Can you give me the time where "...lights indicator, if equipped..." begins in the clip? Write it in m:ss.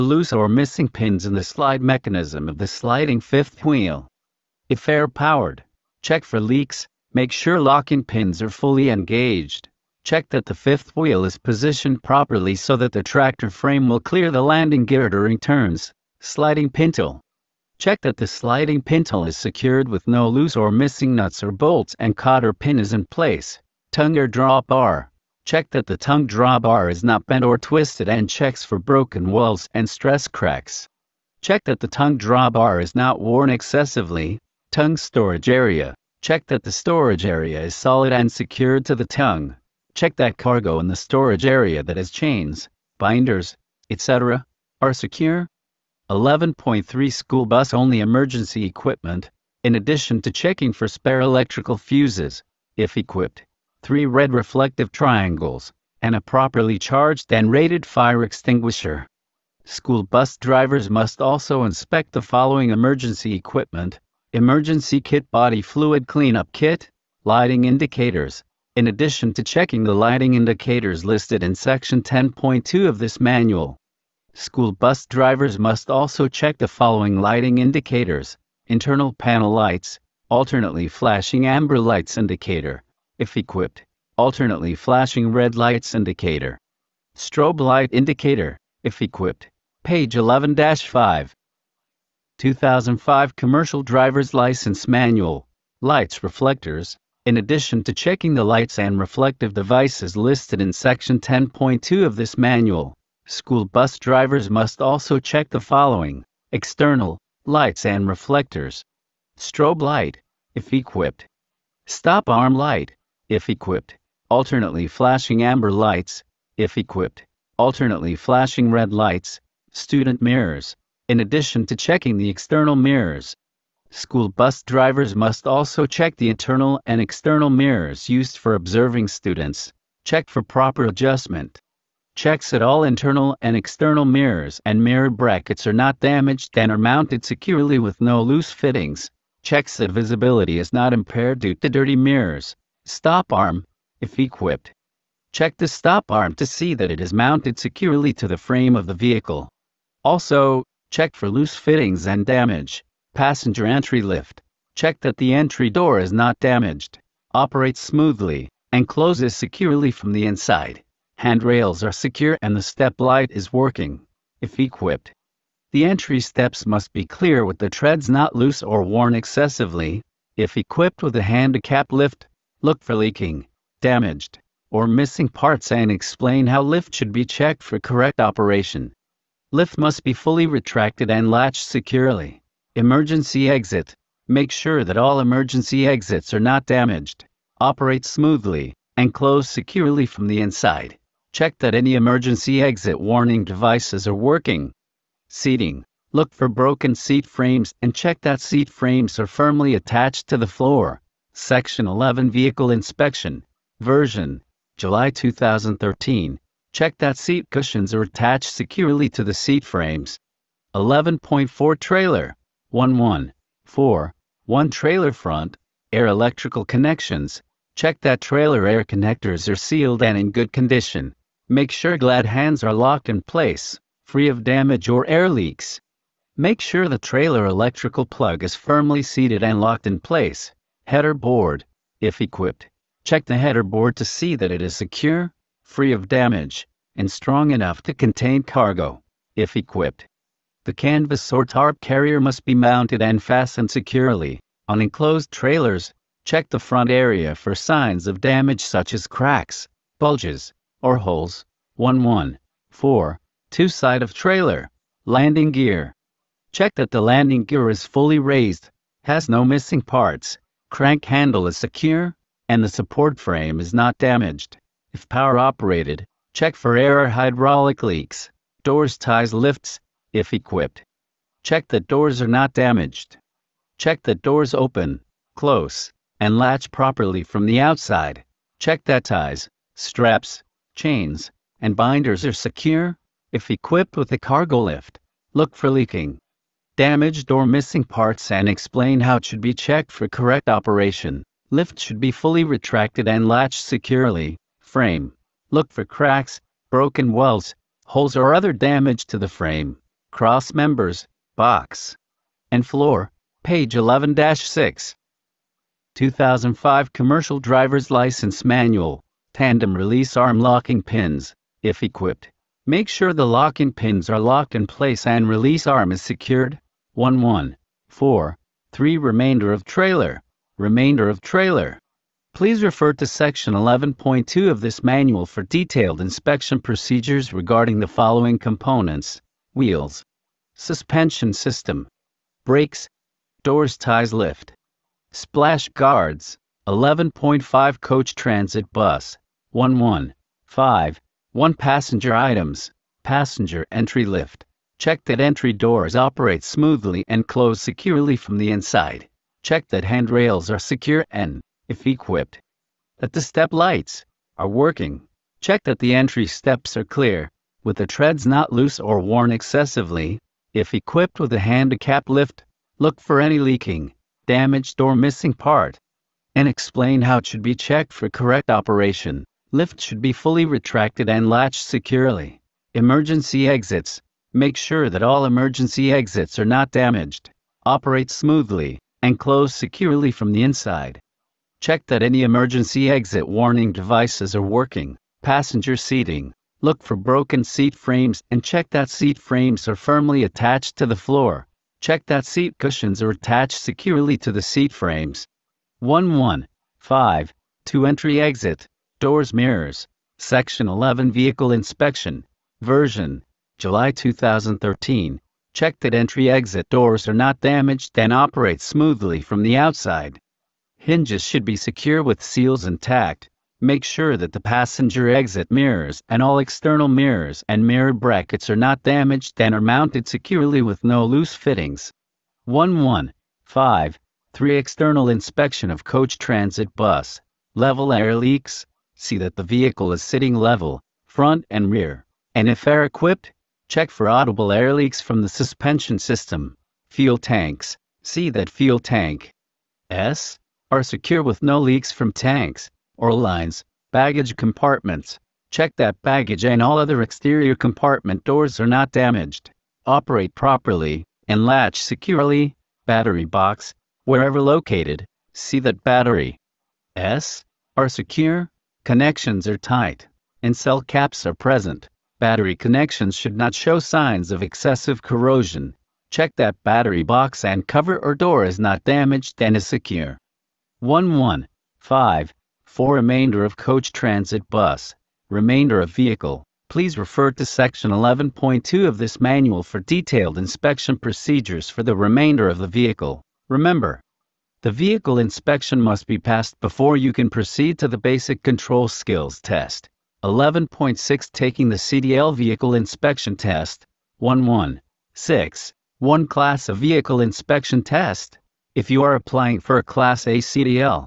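1:21.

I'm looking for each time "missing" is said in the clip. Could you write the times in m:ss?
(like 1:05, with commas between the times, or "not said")
0:00, 0:20, 2:54, 4:19, 4:47, 6:04.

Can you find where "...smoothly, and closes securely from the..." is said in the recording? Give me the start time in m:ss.
2:37.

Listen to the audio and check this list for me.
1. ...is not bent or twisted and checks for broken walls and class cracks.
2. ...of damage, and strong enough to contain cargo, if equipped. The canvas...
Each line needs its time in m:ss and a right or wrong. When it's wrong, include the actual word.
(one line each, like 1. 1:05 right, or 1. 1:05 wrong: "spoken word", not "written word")
1. 0:26 wrong: "stress", not "class"
2. 3:55 right.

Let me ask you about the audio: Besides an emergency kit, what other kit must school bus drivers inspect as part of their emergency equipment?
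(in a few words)
body fluid cleanup kit.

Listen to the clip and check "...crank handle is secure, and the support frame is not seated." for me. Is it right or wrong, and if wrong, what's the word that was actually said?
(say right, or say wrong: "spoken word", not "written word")
wrong: "damaged", not "seated".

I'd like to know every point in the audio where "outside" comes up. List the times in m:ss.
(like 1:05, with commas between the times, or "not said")
4:37, 6:49.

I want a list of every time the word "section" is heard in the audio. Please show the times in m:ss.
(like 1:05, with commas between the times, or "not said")
1:11, 1:40, 3:21, 5:23, 6:40, 7:57.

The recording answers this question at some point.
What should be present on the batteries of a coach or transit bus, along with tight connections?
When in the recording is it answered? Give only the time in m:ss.
7:40.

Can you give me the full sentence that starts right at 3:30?
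11.4 Trailer 11.4 1 Trailer Front Air Electrical Connections Check that trailer air connectors are sealed and in good condition.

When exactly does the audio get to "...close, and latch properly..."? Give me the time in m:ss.
4:35.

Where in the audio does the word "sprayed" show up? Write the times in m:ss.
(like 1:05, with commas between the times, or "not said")
not said.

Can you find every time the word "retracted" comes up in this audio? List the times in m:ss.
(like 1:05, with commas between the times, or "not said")
3:00, 4:52, 6:10.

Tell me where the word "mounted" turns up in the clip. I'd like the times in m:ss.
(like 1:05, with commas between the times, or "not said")
2:16, 2:27, 4:02, 6:59.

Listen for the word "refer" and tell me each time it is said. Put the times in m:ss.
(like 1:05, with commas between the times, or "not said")
5:22, 7:56.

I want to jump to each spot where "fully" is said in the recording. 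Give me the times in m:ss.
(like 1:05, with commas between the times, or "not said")
0:08, 3:00, 4:17, 4:52, 6:10.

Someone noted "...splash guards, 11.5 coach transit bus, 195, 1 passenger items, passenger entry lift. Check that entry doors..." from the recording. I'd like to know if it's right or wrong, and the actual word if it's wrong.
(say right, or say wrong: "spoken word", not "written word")
wrong: "115", not "195".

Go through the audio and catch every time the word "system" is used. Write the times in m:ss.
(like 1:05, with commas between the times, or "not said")
5:31, 7:15.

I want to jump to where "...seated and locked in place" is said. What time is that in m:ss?
3:49.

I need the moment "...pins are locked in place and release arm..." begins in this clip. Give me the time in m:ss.
5:13.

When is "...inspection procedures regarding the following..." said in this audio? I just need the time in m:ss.
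5:25.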